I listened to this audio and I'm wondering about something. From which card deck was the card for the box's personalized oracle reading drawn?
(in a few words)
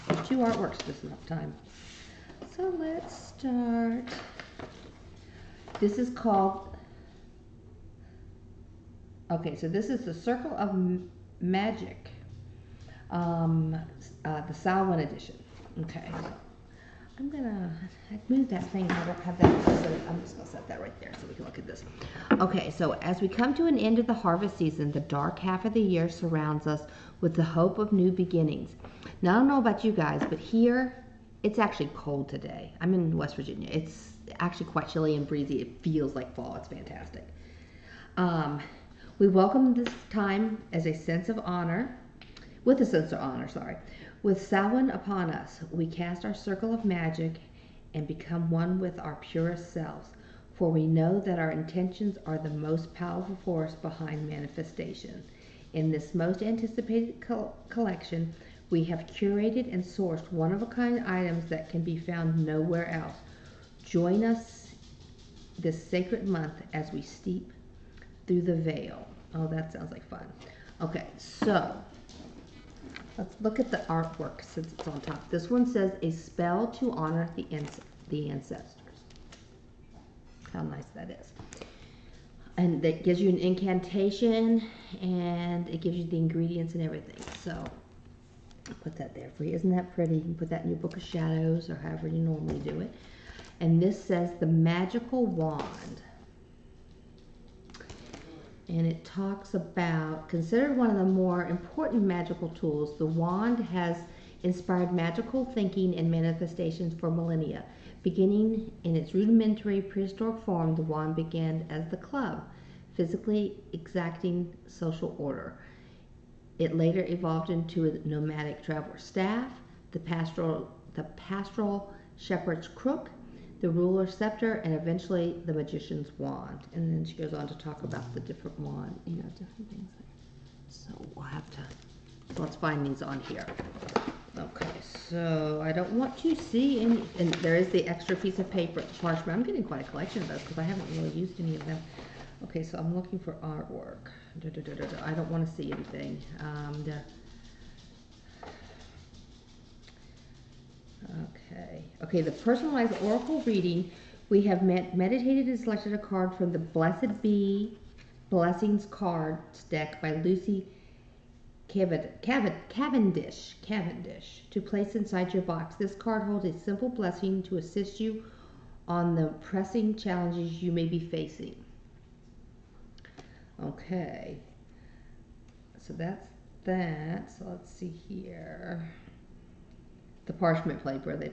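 Blessed Be Blessings.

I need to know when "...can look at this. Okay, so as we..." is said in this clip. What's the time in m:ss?
0:21.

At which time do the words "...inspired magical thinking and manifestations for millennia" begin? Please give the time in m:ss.
1:44.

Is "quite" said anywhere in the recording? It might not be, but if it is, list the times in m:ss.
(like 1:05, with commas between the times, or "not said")
0:34, 2:19.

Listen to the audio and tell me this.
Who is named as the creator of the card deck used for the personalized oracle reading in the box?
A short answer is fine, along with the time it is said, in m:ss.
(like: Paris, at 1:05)
Lucy Cavendish, at 2:40.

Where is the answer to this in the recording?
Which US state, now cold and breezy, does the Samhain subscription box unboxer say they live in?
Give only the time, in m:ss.
0:33.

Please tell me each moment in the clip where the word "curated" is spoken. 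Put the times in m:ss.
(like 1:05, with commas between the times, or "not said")
0:59.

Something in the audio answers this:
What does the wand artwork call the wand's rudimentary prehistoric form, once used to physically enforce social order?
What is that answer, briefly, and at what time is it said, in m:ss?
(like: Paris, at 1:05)
The club, at 1:51.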